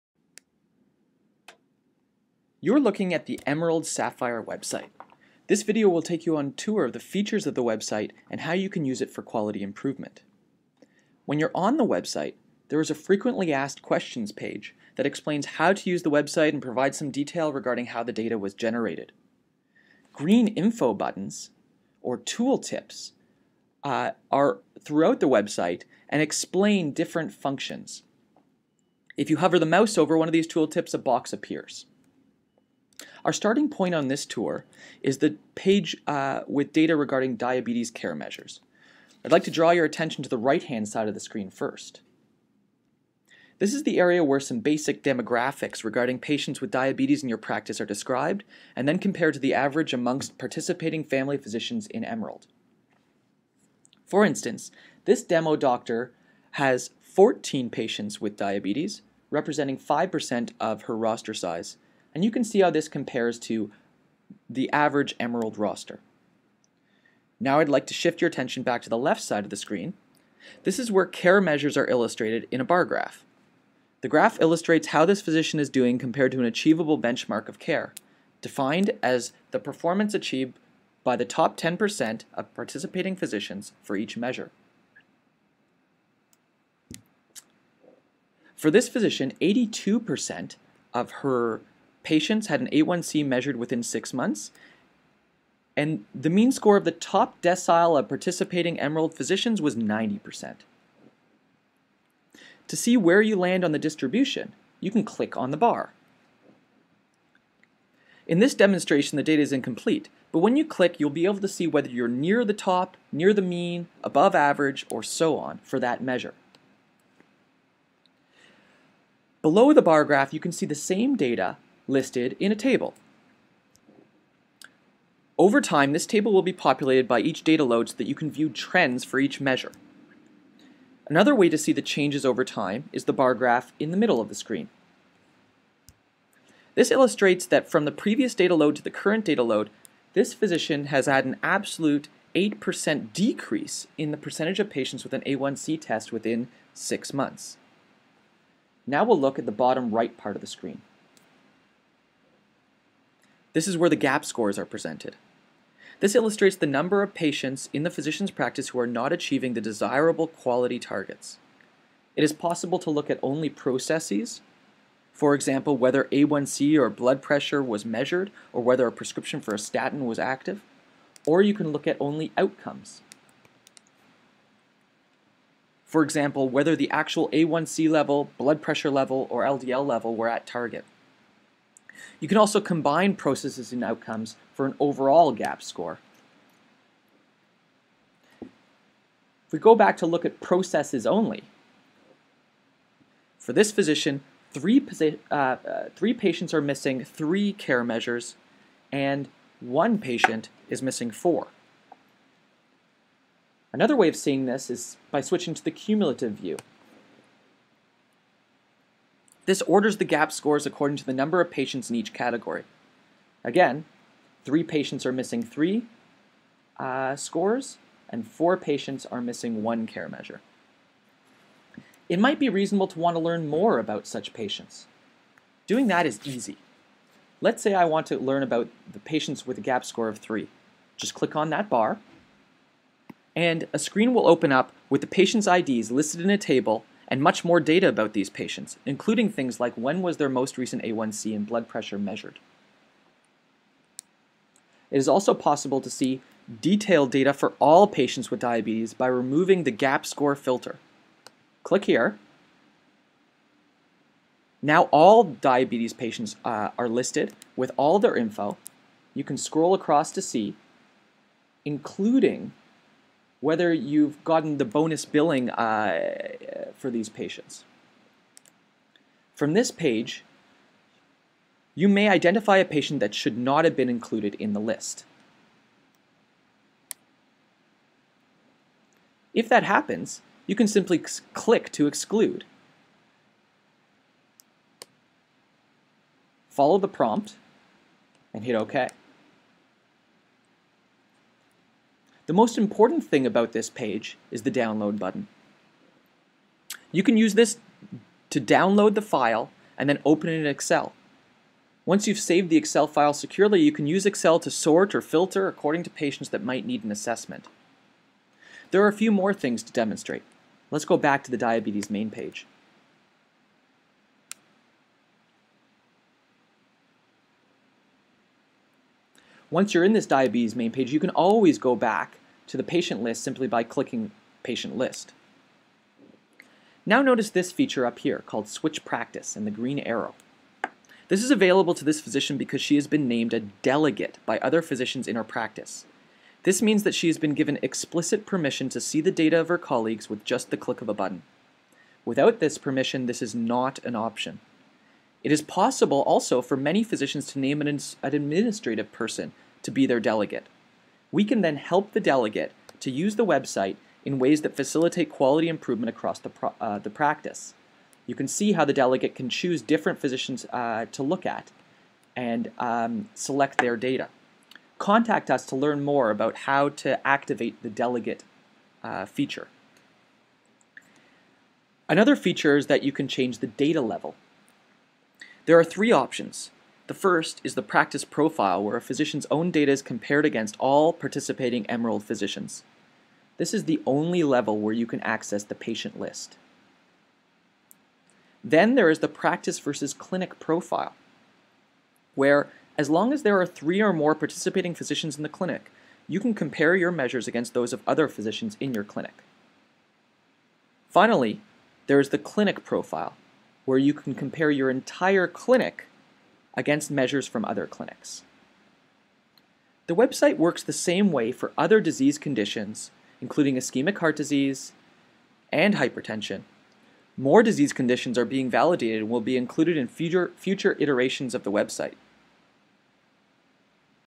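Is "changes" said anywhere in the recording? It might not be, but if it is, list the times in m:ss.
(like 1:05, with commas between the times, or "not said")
2:11, 6:13.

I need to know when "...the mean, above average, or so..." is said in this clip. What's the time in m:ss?
1:53.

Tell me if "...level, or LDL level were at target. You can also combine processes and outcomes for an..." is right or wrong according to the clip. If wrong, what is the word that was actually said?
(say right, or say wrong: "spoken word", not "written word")
right.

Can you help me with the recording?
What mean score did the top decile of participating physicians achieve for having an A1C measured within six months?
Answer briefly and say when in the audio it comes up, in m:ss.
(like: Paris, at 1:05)
90%, at 1:39.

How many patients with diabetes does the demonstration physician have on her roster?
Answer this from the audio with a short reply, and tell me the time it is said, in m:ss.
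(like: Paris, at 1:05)
14, at 0:57.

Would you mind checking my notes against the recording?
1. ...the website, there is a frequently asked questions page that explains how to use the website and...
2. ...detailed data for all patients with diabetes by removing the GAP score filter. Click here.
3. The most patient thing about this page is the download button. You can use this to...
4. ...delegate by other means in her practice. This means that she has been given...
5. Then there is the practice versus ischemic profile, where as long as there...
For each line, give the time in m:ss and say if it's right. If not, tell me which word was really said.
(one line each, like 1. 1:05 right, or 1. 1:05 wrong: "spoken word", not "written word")
1. 0:11 right
2. 4:06 right
3. 4:52 wrong: "important", not "patient"
4. 5:33 wrong: "physicians", not "means"
5. 6:28 wrong: "clinic", not "ischemic".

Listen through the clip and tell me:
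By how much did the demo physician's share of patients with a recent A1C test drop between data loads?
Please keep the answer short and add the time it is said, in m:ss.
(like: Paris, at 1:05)
8%, at 2:22.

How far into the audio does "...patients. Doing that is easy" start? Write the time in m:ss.
3:44.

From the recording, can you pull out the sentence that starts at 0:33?
Our starting point on this tour is the page uh, with data regarding diabetes care measures.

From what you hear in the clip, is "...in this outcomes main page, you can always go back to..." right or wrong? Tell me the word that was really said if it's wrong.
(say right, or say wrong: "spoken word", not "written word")
wrong: "diabetes", not "outcomes".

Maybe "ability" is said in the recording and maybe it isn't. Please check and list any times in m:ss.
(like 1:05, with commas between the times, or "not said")
not said.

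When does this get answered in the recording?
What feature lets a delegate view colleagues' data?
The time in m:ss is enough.
5:28.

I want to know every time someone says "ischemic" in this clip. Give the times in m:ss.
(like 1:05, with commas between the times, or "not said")
6:53.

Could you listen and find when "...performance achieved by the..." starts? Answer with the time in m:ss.
1:19.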